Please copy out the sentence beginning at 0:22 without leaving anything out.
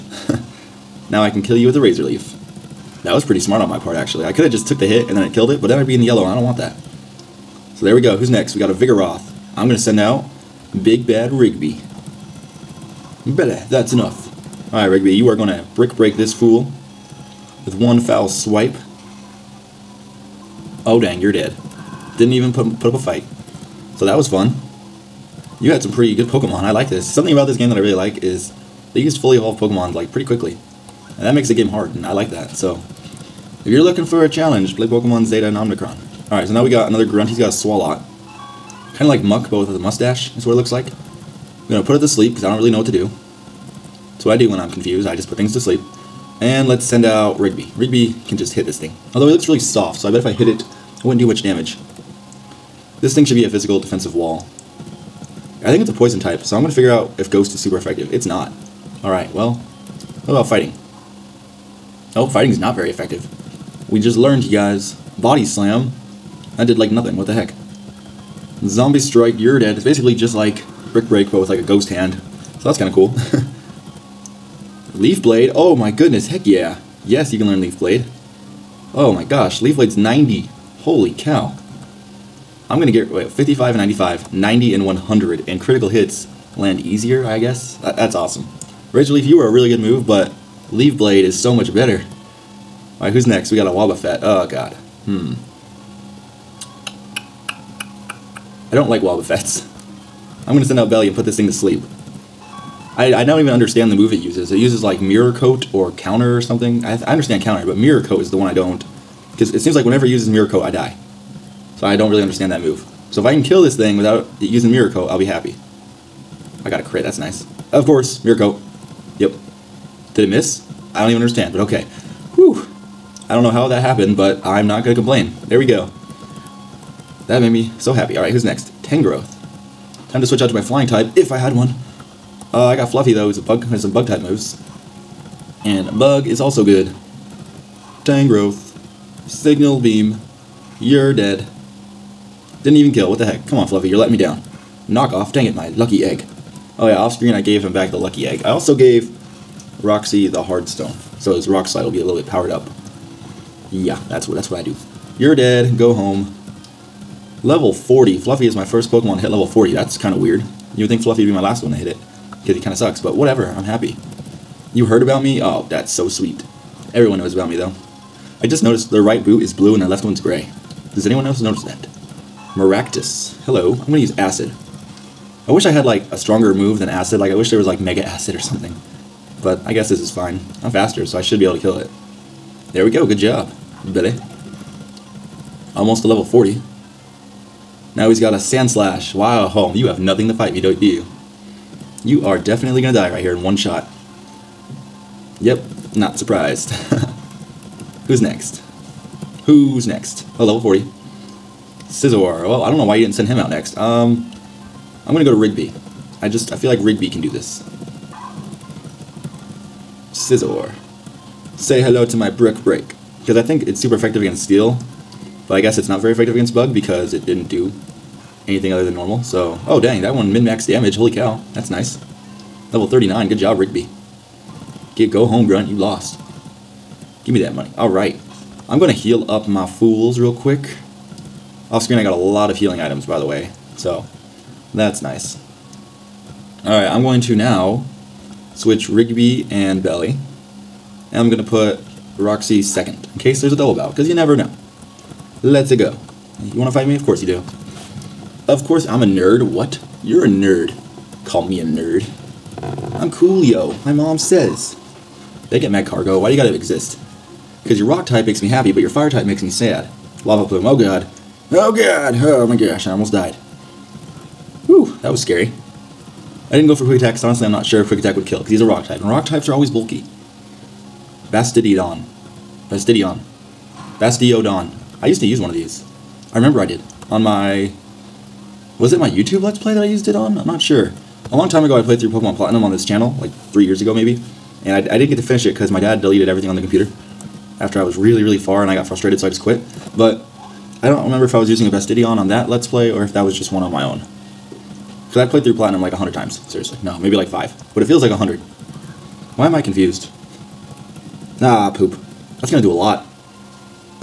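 Didn't even put, put up a fight.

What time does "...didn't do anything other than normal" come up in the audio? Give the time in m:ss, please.
3:37.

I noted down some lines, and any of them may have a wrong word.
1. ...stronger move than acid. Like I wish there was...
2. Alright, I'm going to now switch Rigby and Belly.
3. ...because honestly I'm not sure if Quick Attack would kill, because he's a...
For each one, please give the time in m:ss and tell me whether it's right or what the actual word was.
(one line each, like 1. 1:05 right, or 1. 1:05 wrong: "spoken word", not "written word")
1. 2:56 right
2. 3:56 right
3. 4:27 right.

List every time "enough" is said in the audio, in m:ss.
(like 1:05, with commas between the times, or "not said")
0:13.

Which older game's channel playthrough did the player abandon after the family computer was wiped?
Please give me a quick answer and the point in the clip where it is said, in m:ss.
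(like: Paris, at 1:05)
Pokemon Platinum, at 4:42.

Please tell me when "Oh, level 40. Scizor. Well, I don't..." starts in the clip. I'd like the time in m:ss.
3:20.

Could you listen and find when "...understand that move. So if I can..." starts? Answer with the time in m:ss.
1:52.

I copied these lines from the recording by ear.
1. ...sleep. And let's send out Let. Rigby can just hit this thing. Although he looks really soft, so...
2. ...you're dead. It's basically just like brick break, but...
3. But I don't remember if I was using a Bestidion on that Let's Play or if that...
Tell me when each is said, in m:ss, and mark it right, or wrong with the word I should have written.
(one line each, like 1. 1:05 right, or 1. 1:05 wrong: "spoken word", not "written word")
1. 0:45 wrong: "Rigby", not "Let"
2. 1:09 right
3. 4:49 right.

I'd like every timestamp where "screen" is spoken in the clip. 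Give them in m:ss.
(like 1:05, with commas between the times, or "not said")
2:27, 3:51.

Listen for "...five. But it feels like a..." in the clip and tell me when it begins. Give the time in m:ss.
4:57.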